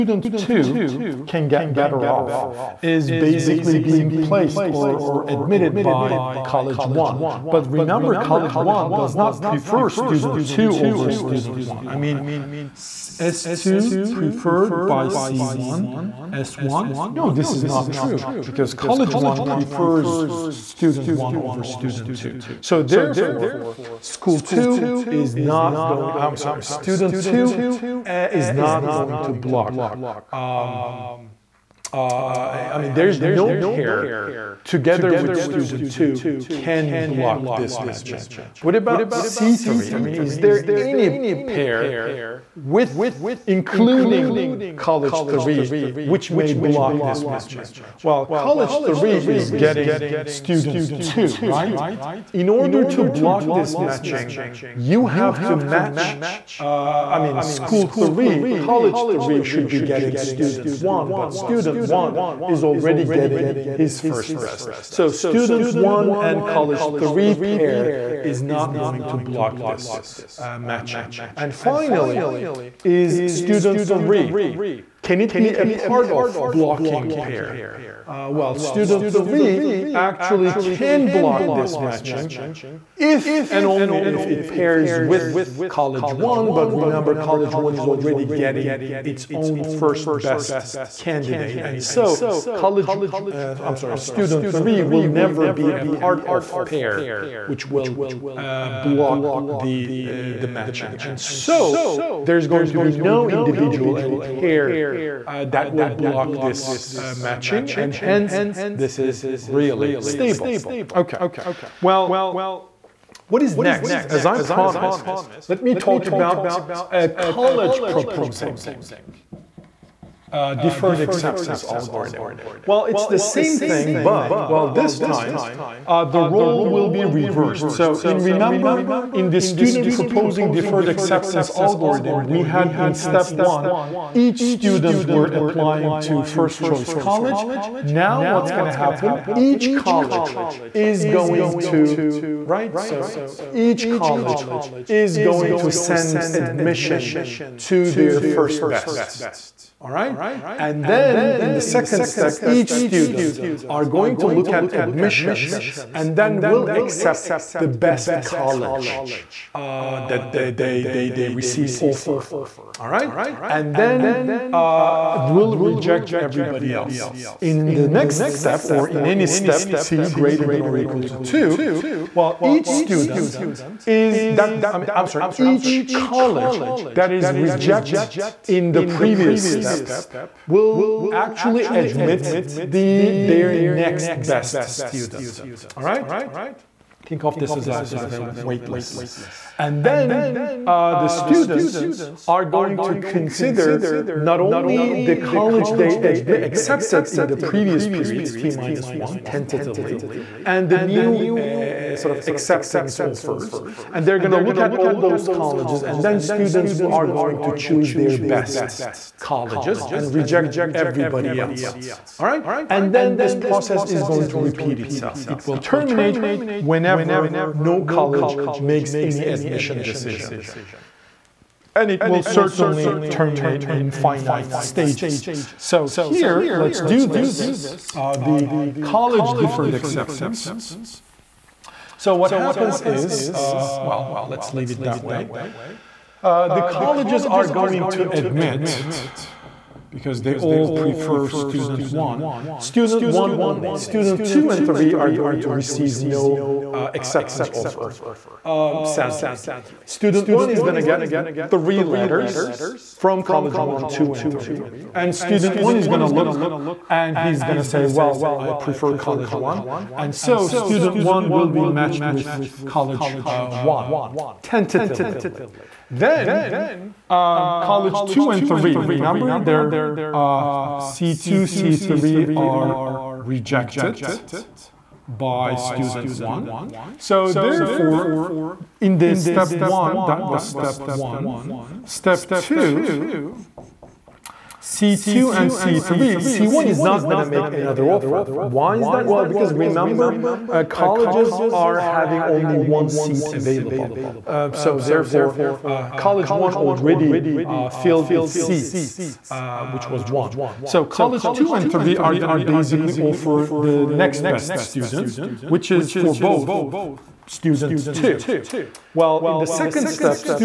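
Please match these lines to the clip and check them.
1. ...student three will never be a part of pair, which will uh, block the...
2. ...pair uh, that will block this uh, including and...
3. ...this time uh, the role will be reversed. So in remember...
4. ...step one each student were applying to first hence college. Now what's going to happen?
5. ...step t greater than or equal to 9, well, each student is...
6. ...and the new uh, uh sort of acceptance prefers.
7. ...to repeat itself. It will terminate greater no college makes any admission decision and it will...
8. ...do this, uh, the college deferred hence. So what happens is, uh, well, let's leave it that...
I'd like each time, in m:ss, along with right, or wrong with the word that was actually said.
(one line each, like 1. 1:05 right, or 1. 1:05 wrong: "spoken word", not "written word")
1. 1:33 right
2. 1:44 wrong: "matching", not "including"
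3. 2:04 right
4. 2:12 wrong: "choice", not "hence"
5. 2:49 wrong: "2", not "9"
6. 3:20 wrong: "offers", not "prefers"
7. 3:34 wrong: "whenever", not "greater"
8. 3:46 wrong: "acceptance", not "hence".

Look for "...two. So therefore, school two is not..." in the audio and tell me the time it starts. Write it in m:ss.
0:22.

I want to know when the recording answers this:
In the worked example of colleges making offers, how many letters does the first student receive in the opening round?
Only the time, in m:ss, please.
4:11.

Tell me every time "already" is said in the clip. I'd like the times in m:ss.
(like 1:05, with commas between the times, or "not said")
1:02, 1:27, 4:56.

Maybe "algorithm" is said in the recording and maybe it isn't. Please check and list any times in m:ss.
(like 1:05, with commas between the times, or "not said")
2:01, 2:11.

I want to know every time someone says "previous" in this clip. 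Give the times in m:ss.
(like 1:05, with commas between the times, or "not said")
2:58, 3:17.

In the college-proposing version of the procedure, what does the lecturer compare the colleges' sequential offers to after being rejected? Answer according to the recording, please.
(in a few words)
A waitlist.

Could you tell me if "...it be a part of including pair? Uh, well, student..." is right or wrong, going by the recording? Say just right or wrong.
wrong.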